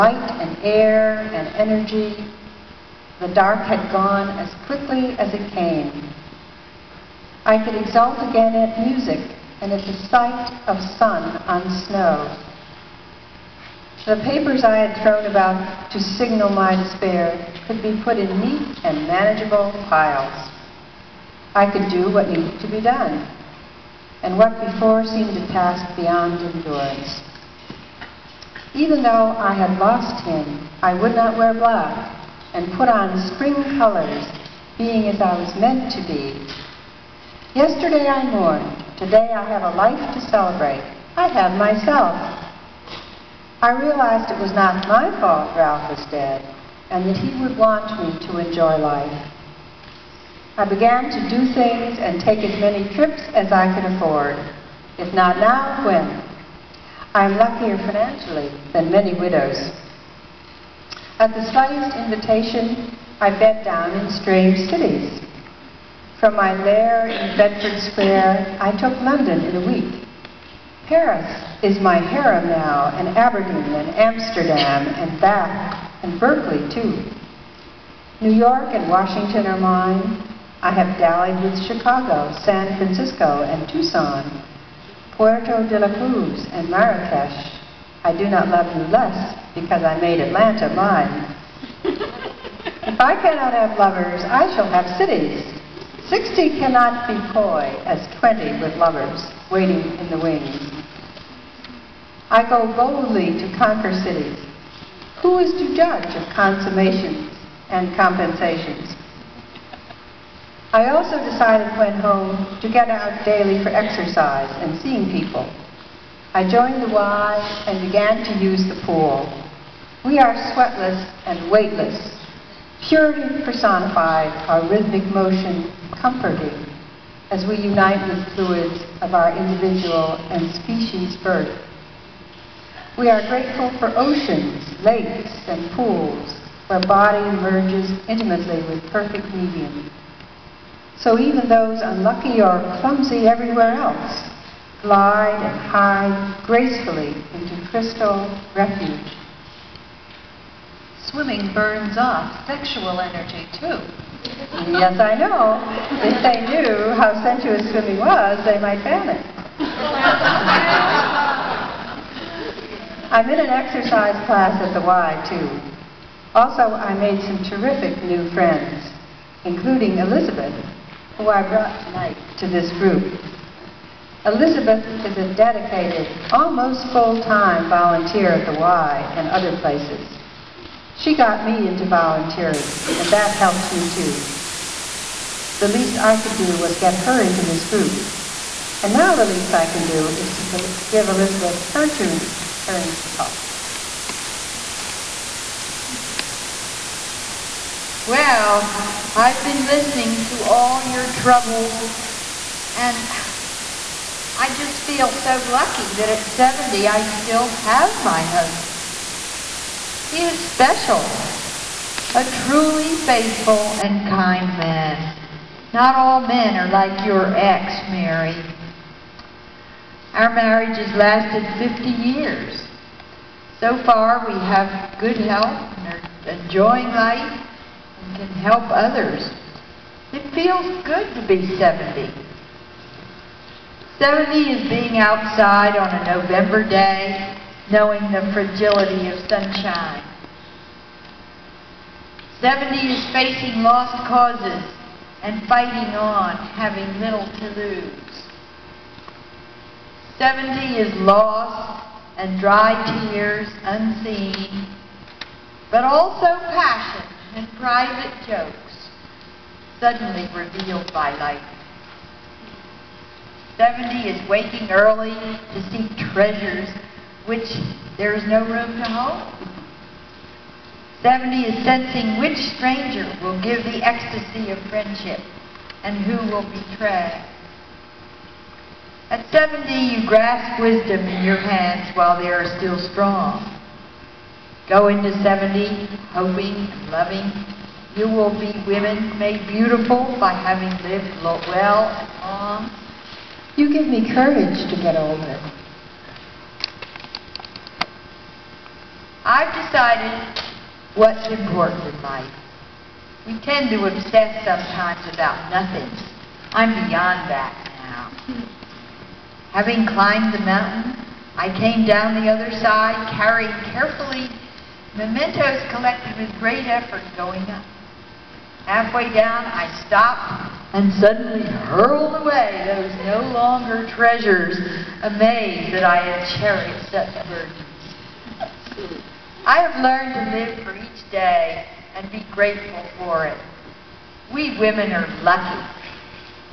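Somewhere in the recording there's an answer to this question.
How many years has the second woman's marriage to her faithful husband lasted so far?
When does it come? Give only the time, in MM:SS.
03:41.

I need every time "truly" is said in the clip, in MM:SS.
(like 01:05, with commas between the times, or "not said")
03:32.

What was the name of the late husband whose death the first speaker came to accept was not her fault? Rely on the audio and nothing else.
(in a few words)
Ralph.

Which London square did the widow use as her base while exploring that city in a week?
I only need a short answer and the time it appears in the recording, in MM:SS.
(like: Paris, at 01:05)
Bedford Square, at 01:07.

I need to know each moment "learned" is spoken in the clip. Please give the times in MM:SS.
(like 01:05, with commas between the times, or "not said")
05:29.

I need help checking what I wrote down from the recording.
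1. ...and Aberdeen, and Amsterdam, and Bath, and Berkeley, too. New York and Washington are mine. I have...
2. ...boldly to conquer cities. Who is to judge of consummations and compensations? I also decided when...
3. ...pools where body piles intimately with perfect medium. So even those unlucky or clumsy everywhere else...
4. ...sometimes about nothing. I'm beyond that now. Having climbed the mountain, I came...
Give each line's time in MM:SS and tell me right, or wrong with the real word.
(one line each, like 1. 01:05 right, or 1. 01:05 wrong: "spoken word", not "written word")
1. 01:12 right
2. 01:42 right
3. 02:15 wrong: "merges", not "piles"
4. 05:04 right.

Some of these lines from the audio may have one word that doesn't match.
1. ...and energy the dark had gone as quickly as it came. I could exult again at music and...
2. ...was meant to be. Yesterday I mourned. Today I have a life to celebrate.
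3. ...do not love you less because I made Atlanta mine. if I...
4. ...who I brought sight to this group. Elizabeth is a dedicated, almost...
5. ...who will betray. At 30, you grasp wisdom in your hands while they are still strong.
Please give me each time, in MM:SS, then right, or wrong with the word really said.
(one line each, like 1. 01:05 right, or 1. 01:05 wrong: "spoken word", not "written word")
1. 00:01 right
2. 00:35 right
3. 01:28 right
4. 02:51 wrong: "tonight", not "sight"
5. 04:36 wrong: "70", not "30".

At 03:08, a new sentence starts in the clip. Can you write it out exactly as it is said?
And now the least I can do is to give Elizabeth her turn, turn to talk.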